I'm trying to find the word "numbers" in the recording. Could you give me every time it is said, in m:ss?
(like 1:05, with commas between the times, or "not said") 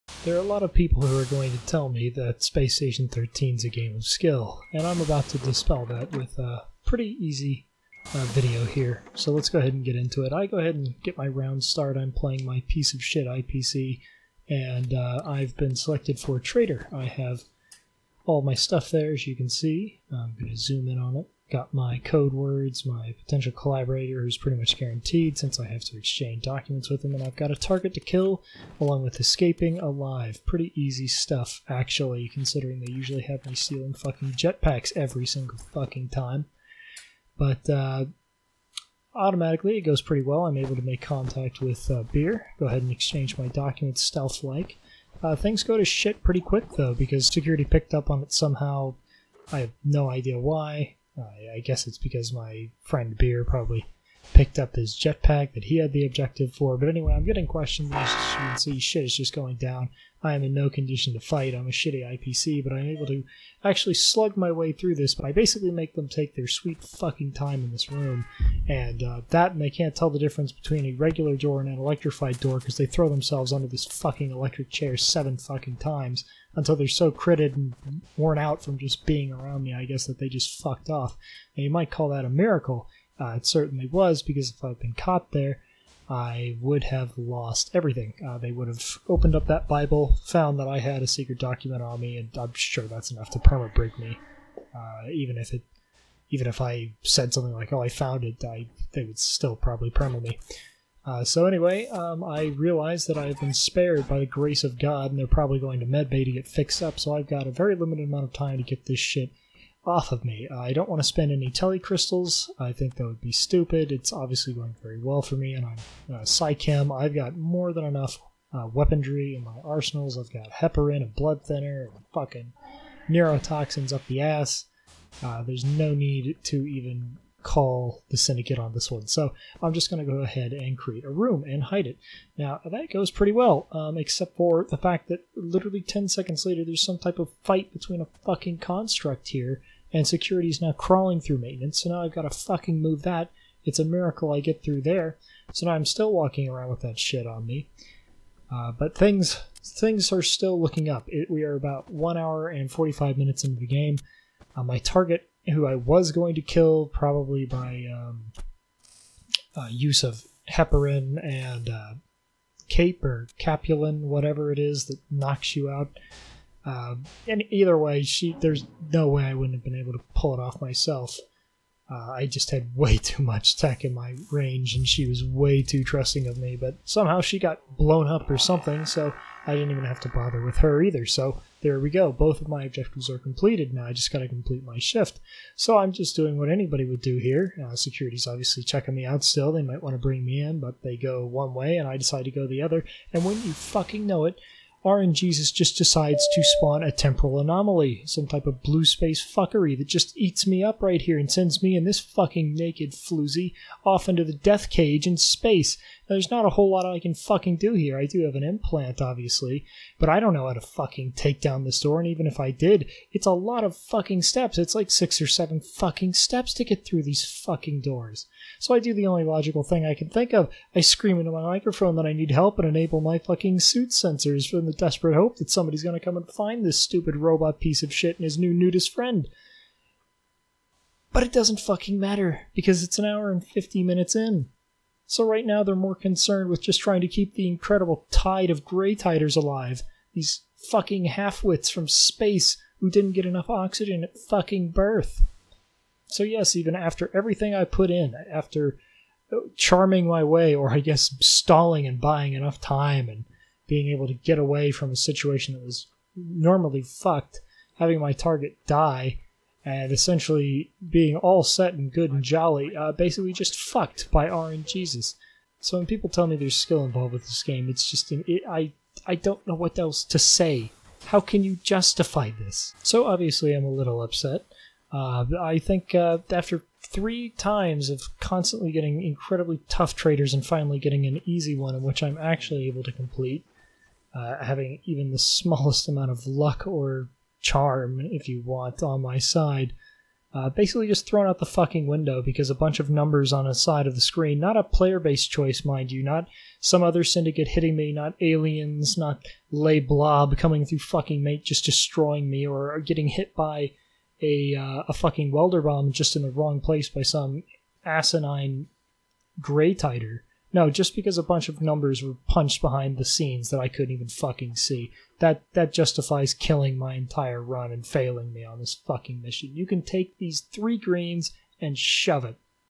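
4:52, 5:11.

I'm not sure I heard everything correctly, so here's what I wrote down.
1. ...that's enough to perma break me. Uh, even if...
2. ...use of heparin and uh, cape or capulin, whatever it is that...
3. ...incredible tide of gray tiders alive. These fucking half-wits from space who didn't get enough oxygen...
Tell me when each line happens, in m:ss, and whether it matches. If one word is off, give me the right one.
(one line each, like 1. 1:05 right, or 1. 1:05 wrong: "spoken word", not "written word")
1. 1:32 right
2. 2:39 right
3. 3:57 right.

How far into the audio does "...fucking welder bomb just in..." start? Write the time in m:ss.
5:04.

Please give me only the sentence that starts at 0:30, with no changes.
Pretty easy stuff, actually, considering they usually have me stealing fucking jetpacks every single fucking time.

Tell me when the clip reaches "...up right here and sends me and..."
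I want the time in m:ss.
3:20.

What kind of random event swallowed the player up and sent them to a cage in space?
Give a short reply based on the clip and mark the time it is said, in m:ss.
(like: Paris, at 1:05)
Temporal anomaly, at 3:16.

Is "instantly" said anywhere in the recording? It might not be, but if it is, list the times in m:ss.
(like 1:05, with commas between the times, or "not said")
not said.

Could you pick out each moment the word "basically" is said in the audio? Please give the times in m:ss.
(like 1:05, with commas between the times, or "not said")
1:05, 4:22, 4:50.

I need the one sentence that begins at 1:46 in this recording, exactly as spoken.
So I've got a very limited amount of time to get this shit off of me.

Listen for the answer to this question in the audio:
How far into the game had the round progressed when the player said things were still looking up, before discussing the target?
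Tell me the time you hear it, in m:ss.
2:31.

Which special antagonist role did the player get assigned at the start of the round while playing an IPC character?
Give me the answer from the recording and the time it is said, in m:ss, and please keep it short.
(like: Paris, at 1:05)
Trader, at 0:16.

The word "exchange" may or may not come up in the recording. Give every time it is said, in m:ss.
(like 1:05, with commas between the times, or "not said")
0:25, 0:42.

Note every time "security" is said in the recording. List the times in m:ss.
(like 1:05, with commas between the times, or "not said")
0:47, 2:20, 3:07.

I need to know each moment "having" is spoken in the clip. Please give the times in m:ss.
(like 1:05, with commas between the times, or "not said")
4:17, 4:44.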